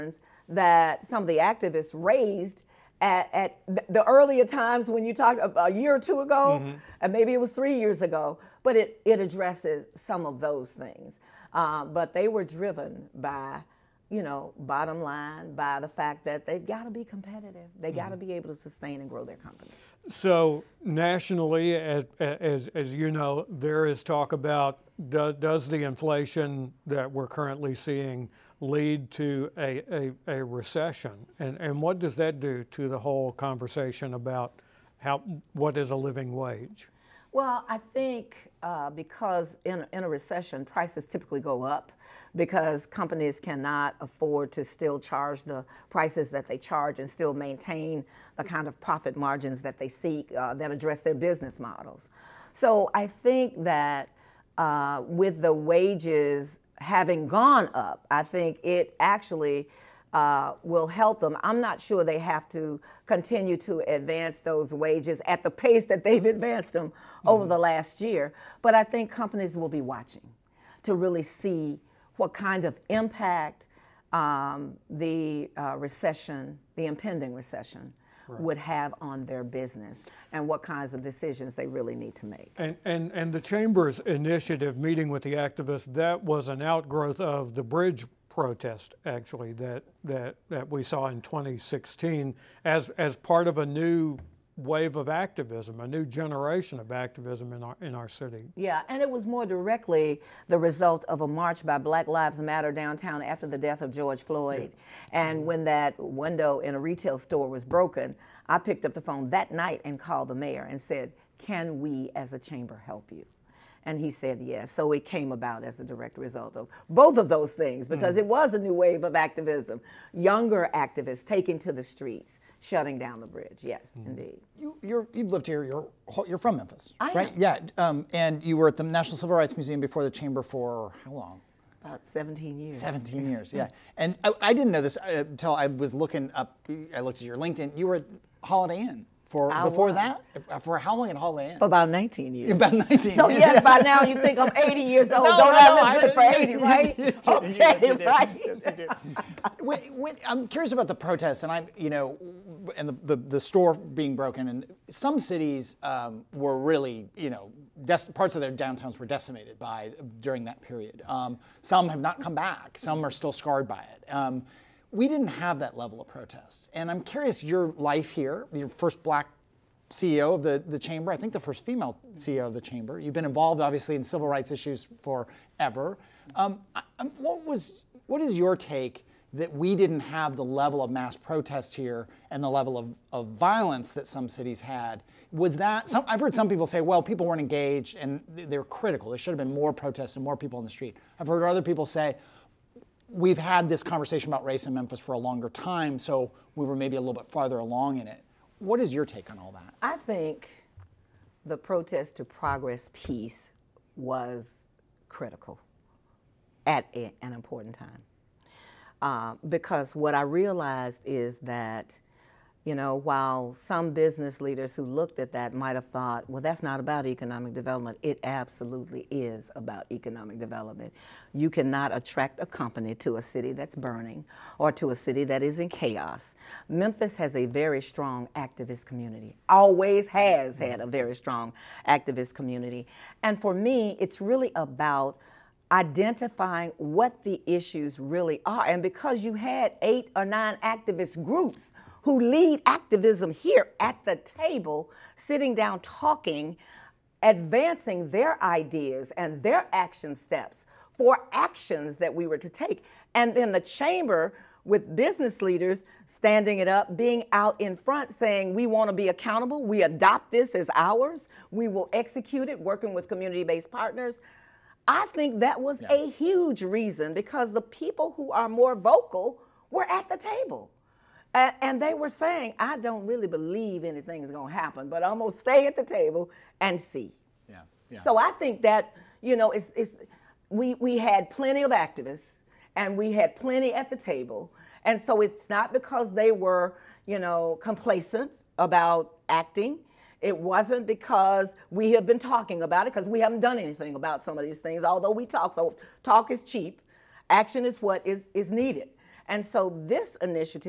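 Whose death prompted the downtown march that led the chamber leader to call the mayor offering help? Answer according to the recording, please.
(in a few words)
George Floyd.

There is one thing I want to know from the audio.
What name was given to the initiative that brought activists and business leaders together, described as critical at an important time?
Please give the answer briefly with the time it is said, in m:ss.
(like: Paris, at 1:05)
Protest to Progress, at 3:21.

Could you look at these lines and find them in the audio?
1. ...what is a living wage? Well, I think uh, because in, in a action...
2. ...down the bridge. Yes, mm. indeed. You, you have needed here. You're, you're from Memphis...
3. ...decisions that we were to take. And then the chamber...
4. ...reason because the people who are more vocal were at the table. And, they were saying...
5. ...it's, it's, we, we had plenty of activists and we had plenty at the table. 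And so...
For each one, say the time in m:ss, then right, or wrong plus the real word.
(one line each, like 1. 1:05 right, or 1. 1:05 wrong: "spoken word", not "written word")
1. 0:35 wrong: "recession", not "action"
2. 2:02 wrong: "lived", not "needed"
3. 4:11 wrong: "actions", not "decisions"
4. 4:26 right
5. 4:39 right.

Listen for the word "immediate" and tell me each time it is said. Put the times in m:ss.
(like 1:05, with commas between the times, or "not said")
not said.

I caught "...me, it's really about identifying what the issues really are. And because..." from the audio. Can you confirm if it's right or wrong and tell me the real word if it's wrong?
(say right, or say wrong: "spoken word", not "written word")
right.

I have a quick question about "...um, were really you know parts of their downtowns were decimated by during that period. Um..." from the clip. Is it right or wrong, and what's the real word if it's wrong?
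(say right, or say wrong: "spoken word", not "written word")
right.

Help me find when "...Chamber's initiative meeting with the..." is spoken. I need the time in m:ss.
1:23.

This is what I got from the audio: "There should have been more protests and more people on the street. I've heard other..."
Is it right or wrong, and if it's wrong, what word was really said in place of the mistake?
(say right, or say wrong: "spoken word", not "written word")
right.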